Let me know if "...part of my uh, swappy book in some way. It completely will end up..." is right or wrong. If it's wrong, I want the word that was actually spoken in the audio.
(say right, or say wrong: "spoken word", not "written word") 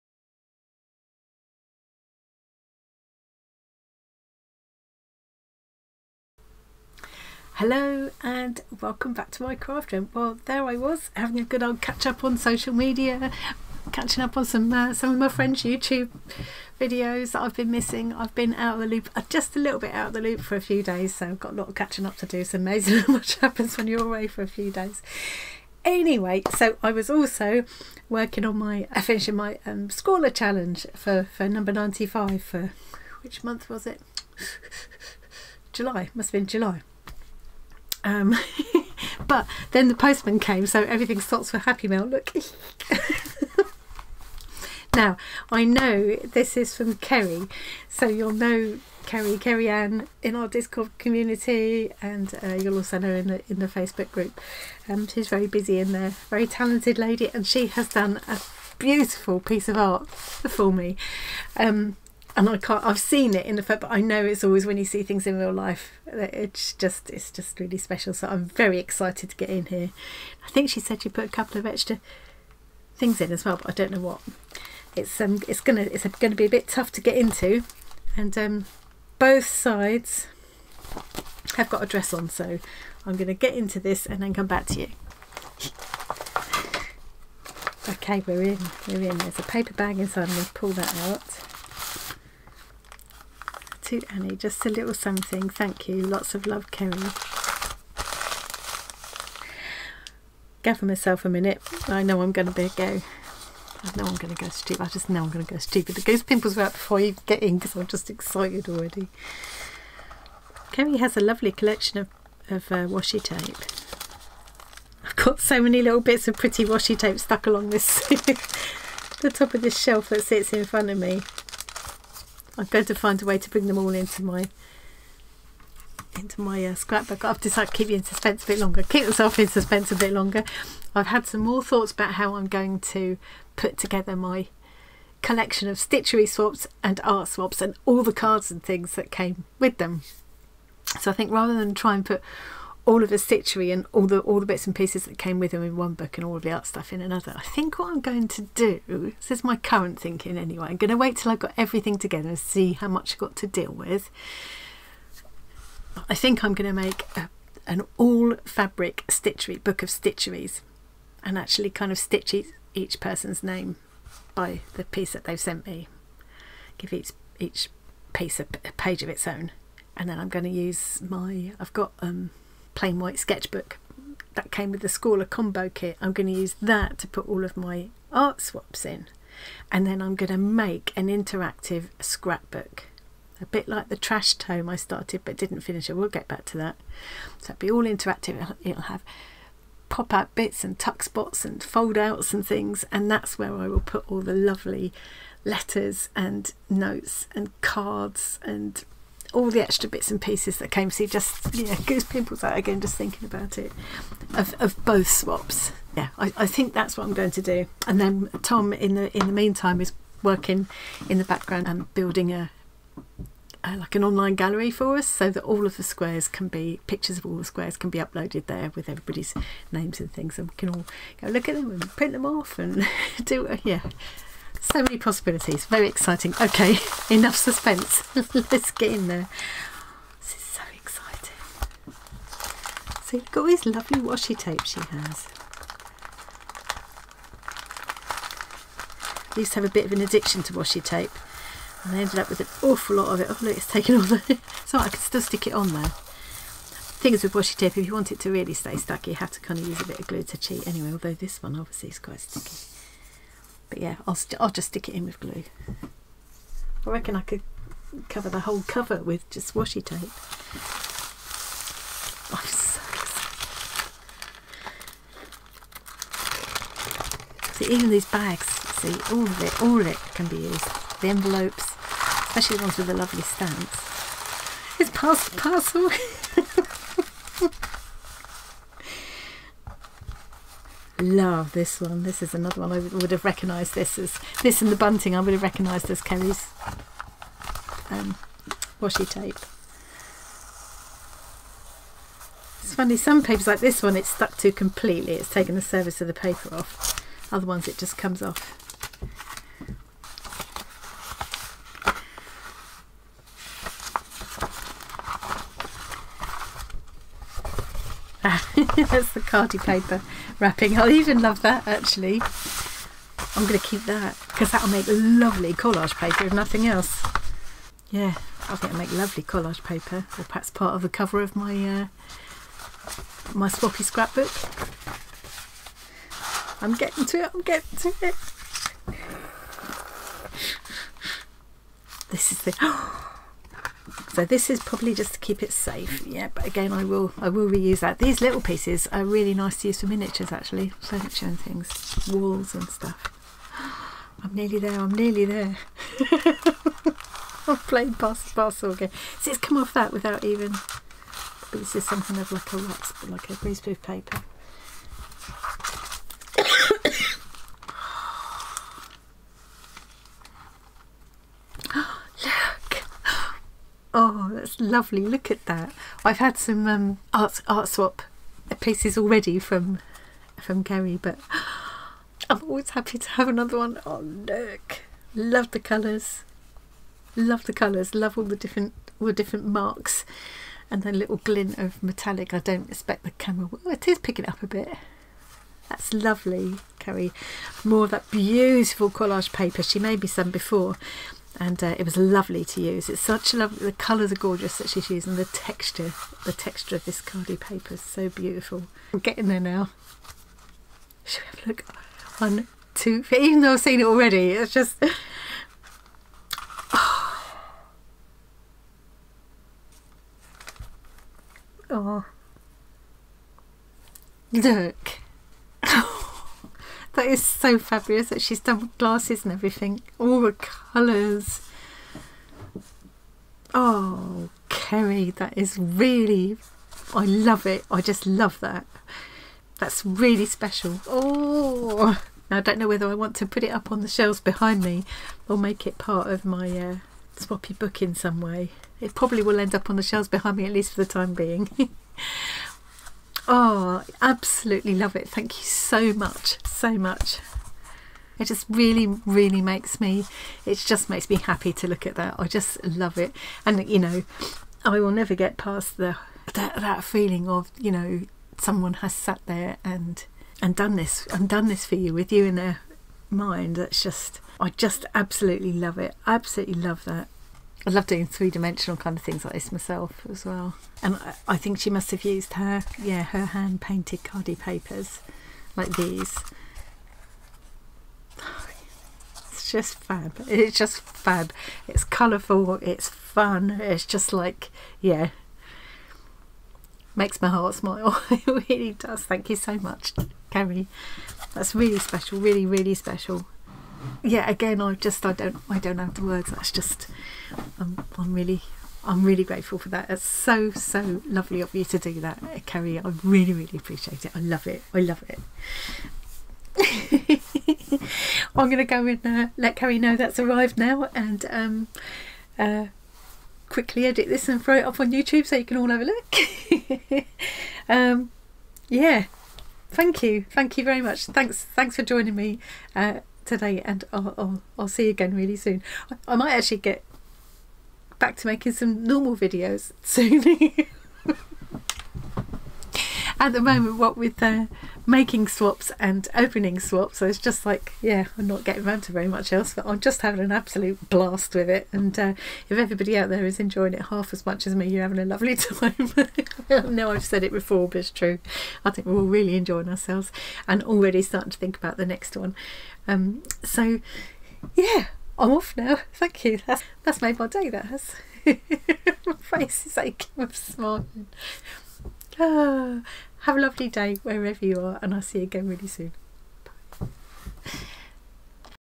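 wrong: "probably", not "completely".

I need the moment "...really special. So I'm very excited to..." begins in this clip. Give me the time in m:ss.
1:07.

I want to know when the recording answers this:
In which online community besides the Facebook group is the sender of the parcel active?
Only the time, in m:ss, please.
0:50.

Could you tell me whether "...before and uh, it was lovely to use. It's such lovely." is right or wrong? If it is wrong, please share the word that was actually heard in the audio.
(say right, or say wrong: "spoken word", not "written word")
right.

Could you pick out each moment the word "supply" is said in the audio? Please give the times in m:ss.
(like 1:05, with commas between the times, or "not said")
not said.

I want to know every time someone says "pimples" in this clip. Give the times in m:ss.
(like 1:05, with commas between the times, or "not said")
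1:46, 3:22.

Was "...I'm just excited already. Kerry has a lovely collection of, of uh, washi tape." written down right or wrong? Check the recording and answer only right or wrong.
right.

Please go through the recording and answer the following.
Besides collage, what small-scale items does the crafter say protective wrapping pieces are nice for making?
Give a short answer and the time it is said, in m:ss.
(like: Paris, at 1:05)
Miniatures, at 5:39.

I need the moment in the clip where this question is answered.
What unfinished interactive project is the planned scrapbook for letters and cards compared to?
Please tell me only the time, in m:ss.
3:03.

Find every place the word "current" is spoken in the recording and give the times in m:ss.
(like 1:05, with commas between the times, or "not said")
2:29.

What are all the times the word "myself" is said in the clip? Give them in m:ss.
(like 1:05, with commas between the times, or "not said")
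1:40, 2:09, 7:49.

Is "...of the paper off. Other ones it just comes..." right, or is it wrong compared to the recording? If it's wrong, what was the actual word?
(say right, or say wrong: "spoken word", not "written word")
right.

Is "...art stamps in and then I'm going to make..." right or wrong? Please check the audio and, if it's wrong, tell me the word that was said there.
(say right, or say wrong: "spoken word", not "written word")
wrong: "swaps", not "stamps".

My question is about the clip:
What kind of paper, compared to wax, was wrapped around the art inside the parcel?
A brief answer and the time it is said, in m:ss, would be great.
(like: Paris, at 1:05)
Greaseproof paper, at 5:53.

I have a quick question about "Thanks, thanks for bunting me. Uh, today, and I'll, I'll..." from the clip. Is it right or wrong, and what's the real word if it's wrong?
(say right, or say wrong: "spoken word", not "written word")
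wrong: "joining", not "bunting".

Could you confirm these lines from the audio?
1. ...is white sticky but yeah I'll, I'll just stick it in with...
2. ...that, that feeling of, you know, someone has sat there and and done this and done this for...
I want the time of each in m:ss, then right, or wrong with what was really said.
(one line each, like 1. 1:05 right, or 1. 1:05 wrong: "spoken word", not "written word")
1. 4:11 wrong: "quite", not "white"
2. 7:36 right.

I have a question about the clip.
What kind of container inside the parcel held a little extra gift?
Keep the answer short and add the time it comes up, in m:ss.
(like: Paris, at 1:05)
A paper bag, at 1:29.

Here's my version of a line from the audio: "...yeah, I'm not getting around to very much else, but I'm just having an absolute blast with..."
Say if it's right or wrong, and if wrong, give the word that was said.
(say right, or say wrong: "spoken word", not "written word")
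right.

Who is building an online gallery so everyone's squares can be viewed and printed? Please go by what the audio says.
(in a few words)
Tom.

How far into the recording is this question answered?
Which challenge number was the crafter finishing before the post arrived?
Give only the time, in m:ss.
0:31.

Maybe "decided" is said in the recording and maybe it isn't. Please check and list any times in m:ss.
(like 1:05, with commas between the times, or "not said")
2:07.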